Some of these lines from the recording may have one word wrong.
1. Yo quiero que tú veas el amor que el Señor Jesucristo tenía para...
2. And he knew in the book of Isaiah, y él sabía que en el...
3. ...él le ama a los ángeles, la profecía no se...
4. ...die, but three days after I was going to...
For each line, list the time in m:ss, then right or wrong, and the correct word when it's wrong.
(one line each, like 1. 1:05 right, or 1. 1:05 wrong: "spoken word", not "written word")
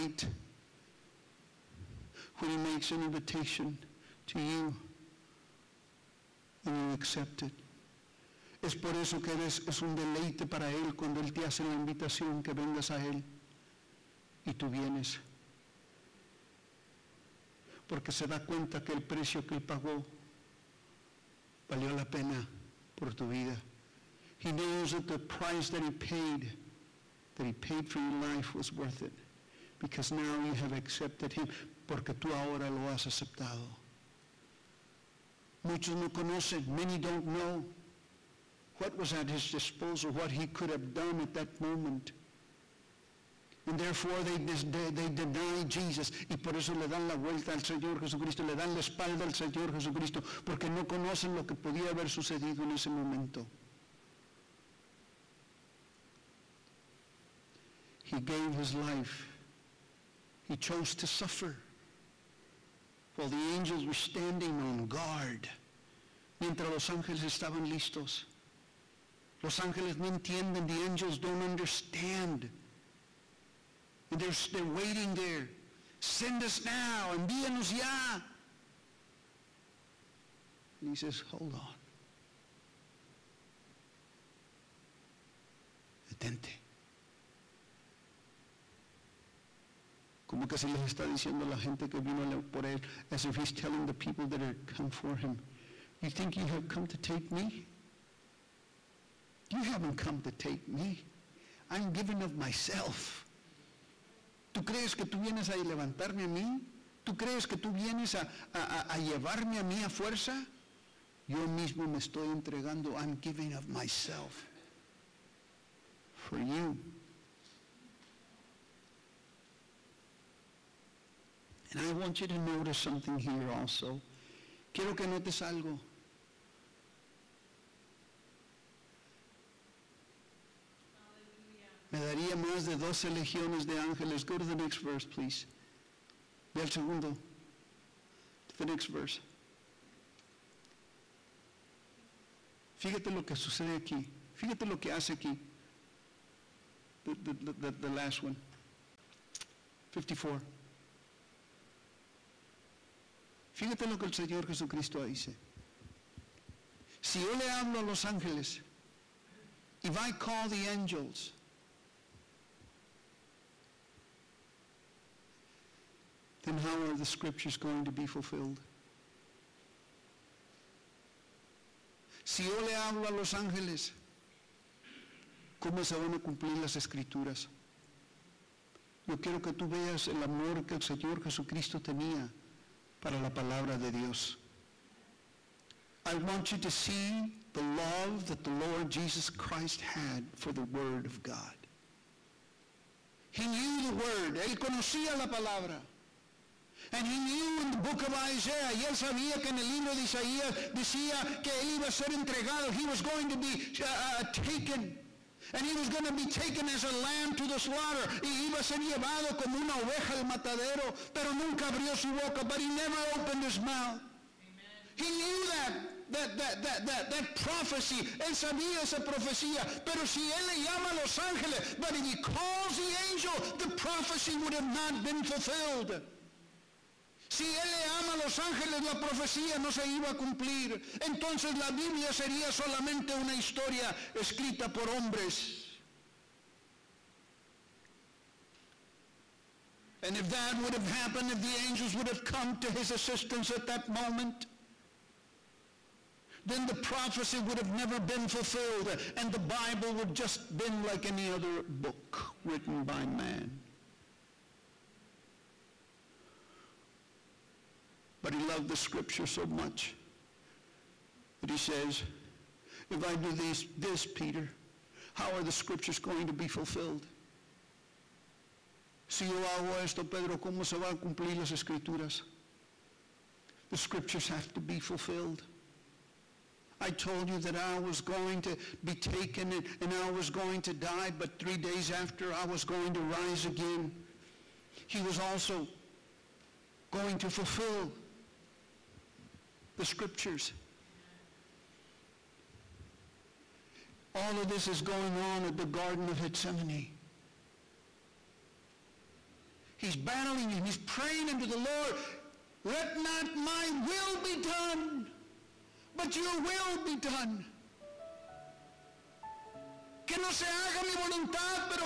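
1. 2:59 right
2. 3:16 right
3. 3:47 right
4. 4:40 right.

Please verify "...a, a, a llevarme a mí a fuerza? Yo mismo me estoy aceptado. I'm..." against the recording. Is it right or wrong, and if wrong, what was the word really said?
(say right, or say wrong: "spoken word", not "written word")
wrong: "entregando", not "aceptado".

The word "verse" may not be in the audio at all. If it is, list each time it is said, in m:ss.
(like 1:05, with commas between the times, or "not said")
2:14, 2:18.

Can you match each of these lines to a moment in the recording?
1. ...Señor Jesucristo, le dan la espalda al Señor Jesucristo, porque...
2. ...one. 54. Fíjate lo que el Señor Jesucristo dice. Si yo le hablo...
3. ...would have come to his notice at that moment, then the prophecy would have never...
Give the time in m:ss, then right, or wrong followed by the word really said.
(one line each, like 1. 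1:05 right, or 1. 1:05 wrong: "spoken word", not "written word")
1. 0:47 right
2. 2:28 right
3. 4:01 wrong: "assistance", not "notice".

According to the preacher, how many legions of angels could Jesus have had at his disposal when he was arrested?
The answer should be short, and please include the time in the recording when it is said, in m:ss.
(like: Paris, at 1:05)
more than 12, at 2:12.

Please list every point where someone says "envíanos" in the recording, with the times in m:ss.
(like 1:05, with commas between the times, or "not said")
1:17.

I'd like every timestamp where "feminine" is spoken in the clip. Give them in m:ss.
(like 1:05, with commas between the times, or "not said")
not said.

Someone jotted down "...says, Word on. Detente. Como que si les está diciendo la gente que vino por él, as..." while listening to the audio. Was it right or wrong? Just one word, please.
wrong.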